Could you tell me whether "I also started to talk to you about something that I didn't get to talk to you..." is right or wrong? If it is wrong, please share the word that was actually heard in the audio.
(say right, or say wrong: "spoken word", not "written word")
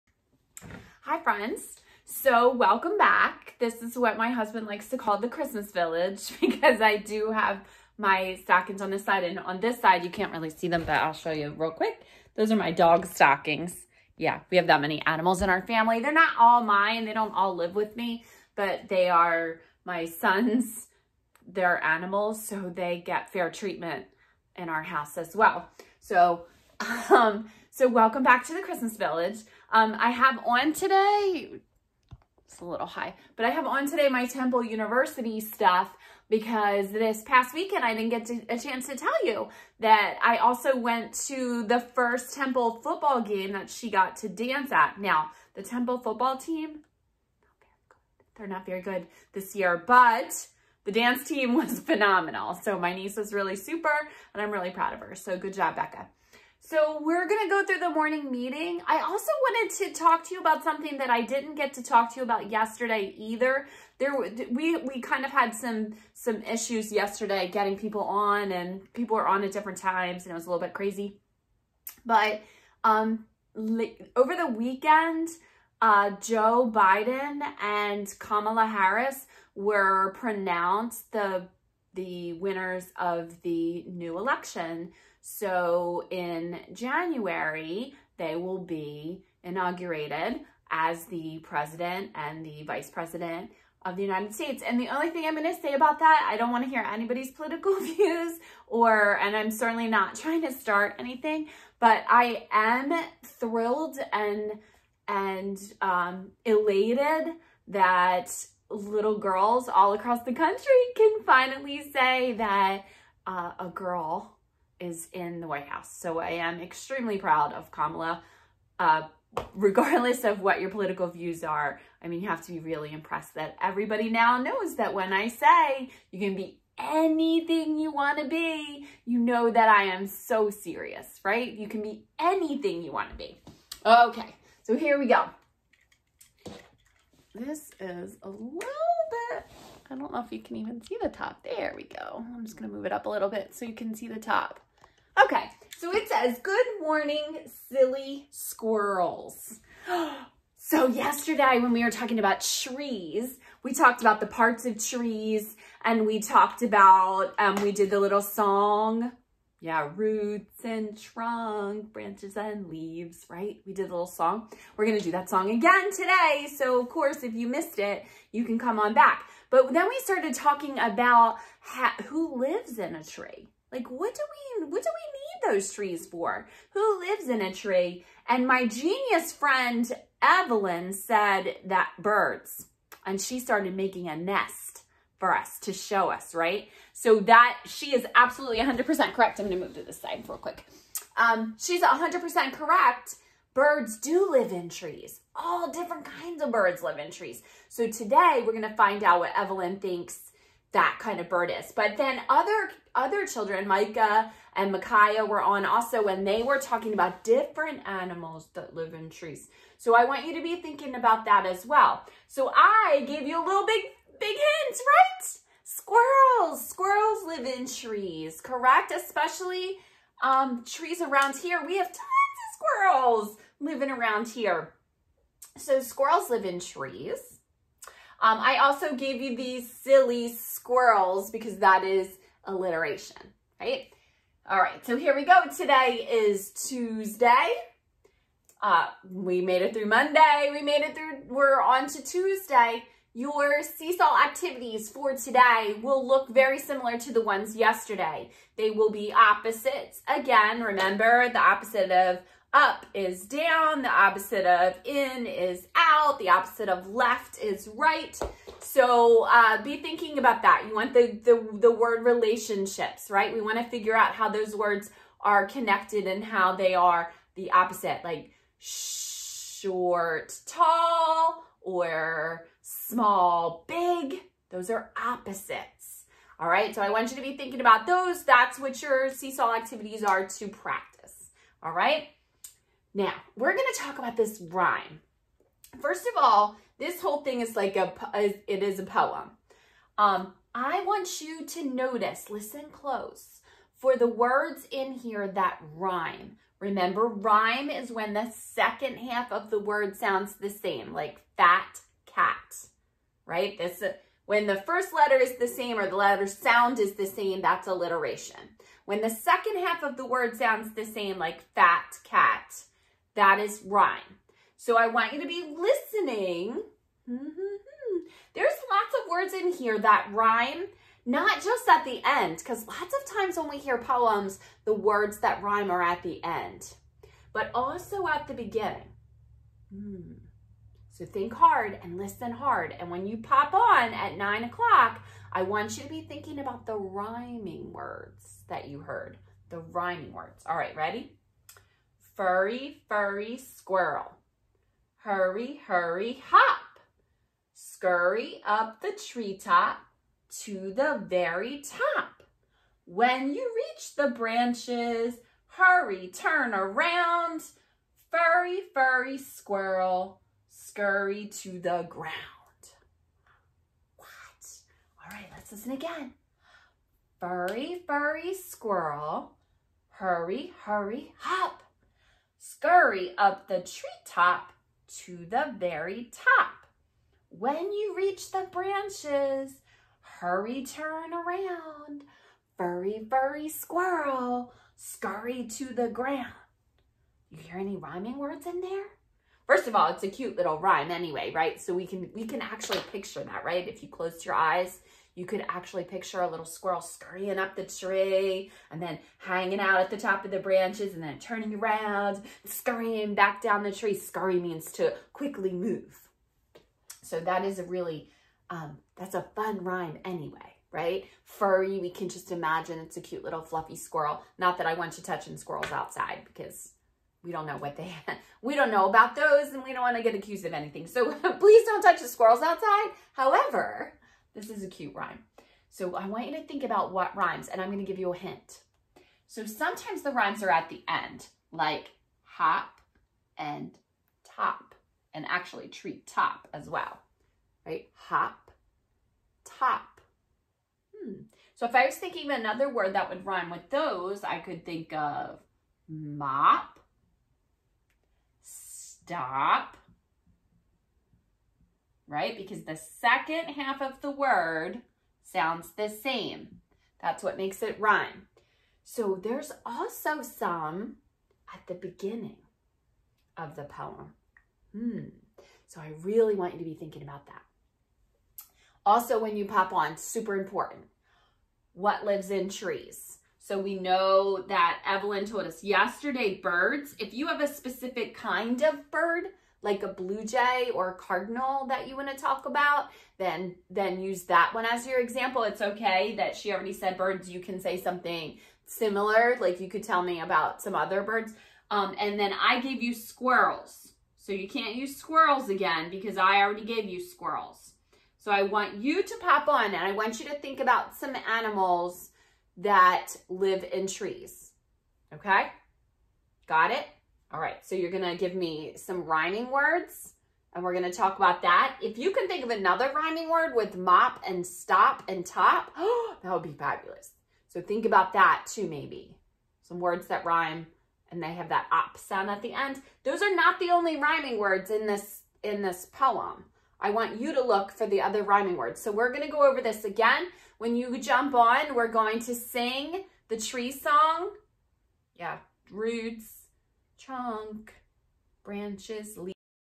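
wrong: "wanted", not "started".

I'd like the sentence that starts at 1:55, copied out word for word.
So I am extremely proud of Kamala.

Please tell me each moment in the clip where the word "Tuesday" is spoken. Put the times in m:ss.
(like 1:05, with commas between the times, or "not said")
3:56, 4:02.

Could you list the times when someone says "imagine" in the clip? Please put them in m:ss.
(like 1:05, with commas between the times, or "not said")
6:52.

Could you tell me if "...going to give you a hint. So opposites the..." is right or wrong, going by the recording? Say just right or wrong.
wrong.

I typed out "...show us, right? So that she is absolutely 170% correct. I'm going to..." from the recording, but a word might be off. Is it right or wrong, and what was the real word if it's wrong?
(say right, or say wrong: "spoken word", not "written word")
wrong: "100", not "170".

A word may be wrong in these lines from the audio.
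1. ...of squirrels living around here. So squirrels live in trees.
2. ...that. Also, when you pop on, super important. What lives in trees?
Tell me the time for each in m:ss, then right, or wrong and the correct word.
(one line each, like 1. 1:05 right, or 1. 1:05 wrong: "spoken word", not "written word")
1. 3:41 right
2. 7:47 right.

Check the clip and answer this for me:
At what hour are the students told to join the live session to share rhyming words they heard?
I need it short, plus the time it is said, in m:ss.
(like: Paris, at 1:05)
9 o'clock, at 5:34.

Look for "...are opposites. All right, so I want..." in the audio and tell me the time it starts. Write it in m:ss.
4:34.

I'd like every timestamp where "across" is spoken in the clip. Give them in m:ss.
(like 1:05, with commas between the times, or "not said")
1:49.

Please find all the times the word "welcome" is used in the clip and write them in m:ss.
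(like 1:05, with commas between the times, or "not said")
0:02, 0:27.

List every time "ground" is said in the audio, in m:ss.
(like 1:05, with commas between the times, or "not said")
6:01, 6:25.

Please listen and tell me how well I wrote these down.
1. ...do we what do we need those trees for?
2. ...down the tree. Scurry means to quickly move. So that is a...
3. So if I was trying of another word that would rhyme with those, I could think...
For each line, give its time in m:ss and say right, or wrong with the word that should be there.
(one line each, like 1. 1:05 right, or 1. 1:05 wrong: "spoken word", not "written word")
1. 2:54 right
2. 6:43 right
3. 7:21 wrong: "thinking", not "trying".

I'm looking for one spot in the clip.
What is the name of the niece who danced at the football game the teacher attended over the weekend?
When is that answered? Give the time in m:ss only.
0:55.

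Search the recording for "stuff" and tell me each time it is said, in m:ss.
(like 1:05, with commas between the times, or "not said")
0:35.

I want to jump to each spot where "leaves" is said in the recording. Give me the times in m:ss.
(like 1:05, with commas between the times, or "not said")
2:42, 8:59.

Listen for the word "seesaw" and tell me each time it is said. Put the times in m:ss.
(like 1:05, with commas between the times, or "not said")
4:03, 4:39.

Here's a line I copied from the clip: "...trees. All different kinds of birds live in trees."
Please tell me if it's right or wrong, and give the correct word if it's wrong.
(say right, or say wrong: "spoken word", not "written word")
right.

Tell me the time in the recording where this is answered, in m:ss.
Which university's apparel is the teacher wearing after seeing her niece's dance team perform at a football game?
0:34.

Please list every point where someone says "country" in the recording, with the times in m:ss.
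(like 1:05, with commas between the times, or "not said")
1:50.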